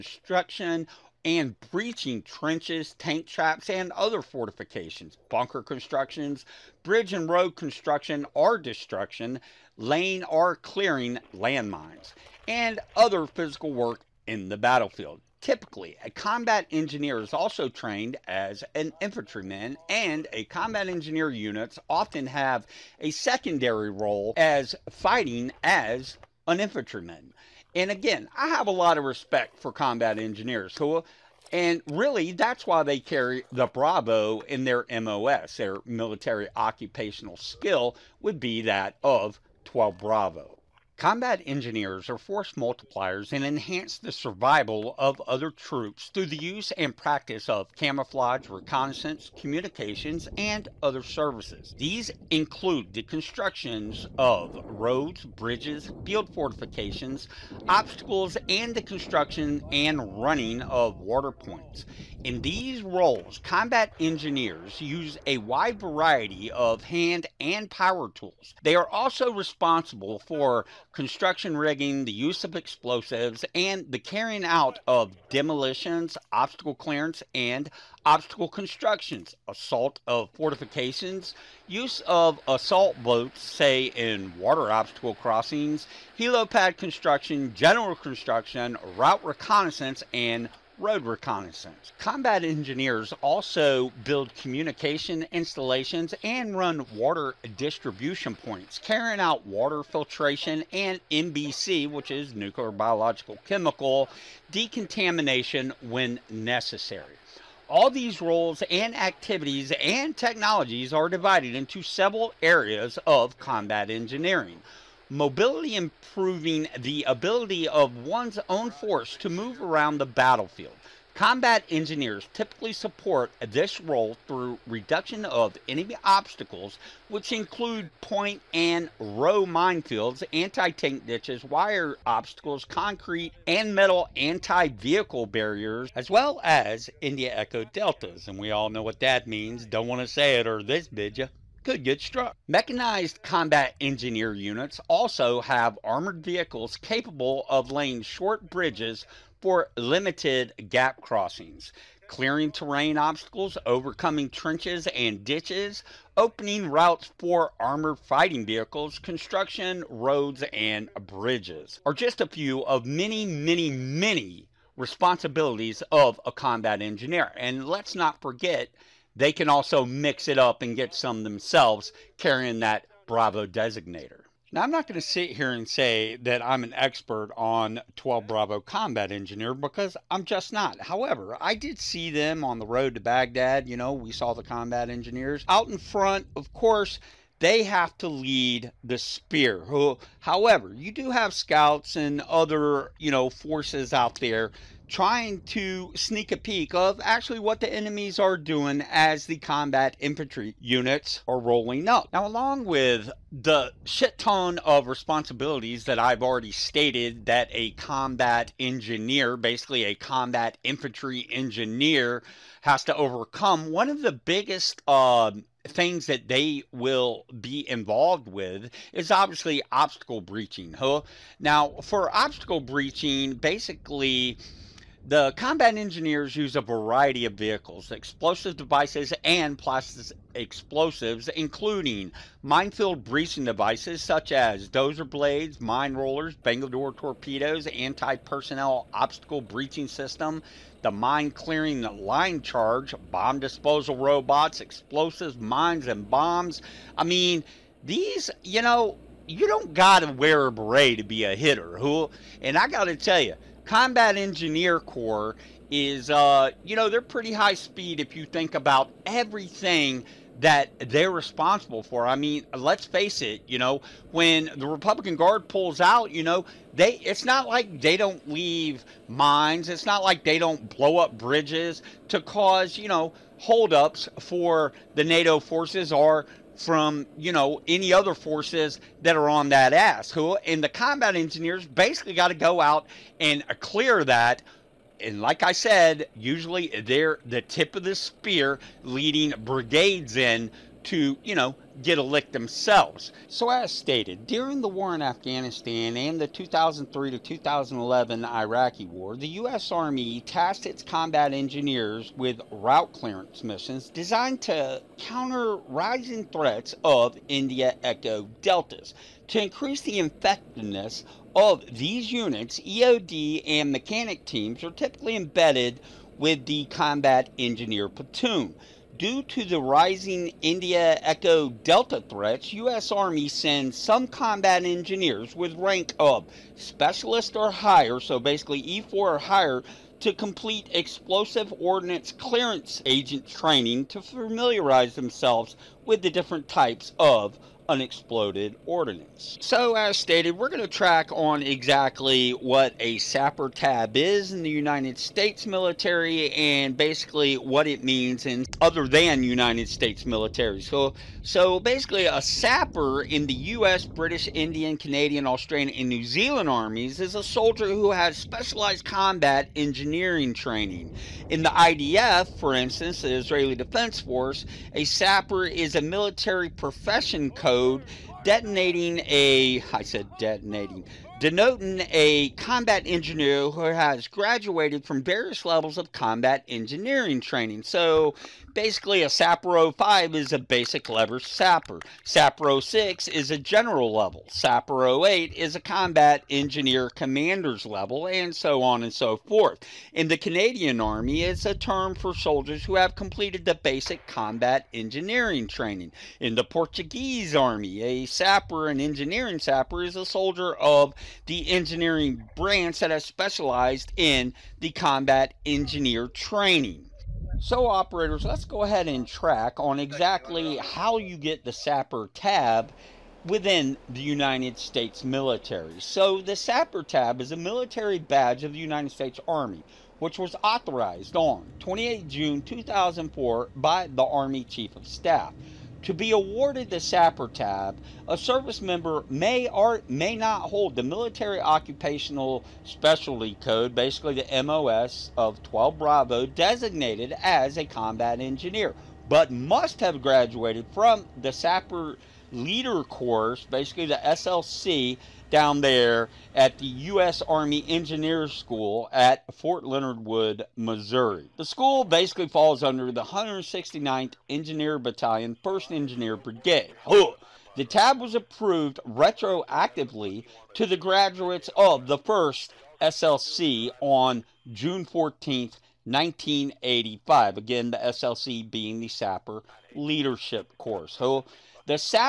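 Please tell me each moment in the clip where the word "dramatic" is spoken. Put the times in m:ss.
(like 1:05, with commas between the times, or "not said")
not said.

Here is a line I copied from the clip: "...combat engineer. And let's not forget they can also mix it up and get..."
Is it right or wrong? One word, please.
right.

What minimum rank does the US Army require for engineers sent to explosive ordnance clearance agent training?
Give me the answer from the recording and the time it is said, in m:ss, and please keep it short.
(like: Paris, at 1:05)
Specialist, at 5:26.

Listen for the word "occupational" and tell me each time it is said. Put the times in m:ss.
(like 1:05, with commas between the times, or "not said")
0:36, 7:11.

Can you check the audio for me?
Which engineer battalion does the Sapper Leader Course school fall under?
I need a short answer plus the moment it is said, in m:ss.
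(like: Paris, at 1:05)
169th Engineer Battalion, at 7:33.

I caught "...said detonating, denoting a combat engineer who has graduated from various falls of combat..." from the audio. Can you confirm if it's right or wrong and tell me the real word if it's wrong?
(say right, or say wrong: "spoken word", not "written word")
wrong: "levels", not "falls".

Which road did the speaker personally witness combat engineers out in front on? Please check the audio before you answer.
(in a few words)
The road to Baghdad.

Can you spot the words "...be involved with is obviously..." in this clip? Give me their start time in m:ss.
3:37.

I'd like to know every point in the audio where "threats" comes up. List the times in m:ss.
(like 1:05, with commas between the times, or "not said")
5:06, 5:22.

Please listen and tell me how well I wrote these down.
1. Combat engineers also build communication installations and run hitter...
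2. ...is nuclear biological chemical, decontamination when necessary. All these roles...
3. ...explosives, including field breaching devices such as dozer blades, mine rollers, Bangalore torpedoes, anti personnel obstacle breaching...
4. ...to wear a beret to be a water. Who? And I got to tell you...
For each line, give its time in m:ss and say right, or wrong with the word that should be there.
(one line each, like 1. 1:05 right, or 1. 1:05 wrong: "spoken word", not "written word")
1. 1:31 wrong: "water", not "hitter"
2. 1:42 right
3. 3:50 wrong: "minefield", not "field"
4. 4:10 wrong: "hitter", not "water".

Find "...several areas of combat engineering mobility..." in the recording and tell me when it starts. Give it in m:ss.
1:51.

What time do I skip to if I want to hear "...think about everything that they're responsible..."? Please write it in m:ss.
4:18.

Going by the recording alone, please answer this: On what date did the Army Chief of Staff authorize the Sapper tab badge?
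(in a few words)
28 June 2004.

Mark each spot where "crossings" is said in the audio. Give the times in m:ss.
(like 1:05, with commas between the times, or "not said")
1:25, 2:30.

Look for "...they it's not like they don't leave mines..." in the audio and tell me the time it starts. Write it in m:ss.
4:26.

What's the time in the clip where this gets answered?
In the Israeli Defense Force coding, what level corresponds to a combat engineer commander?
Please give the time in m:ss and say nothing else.
6:24.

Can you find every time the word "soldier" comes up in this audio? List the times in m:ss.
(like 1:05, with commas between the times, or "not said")
5:57, 6:32, 6:40.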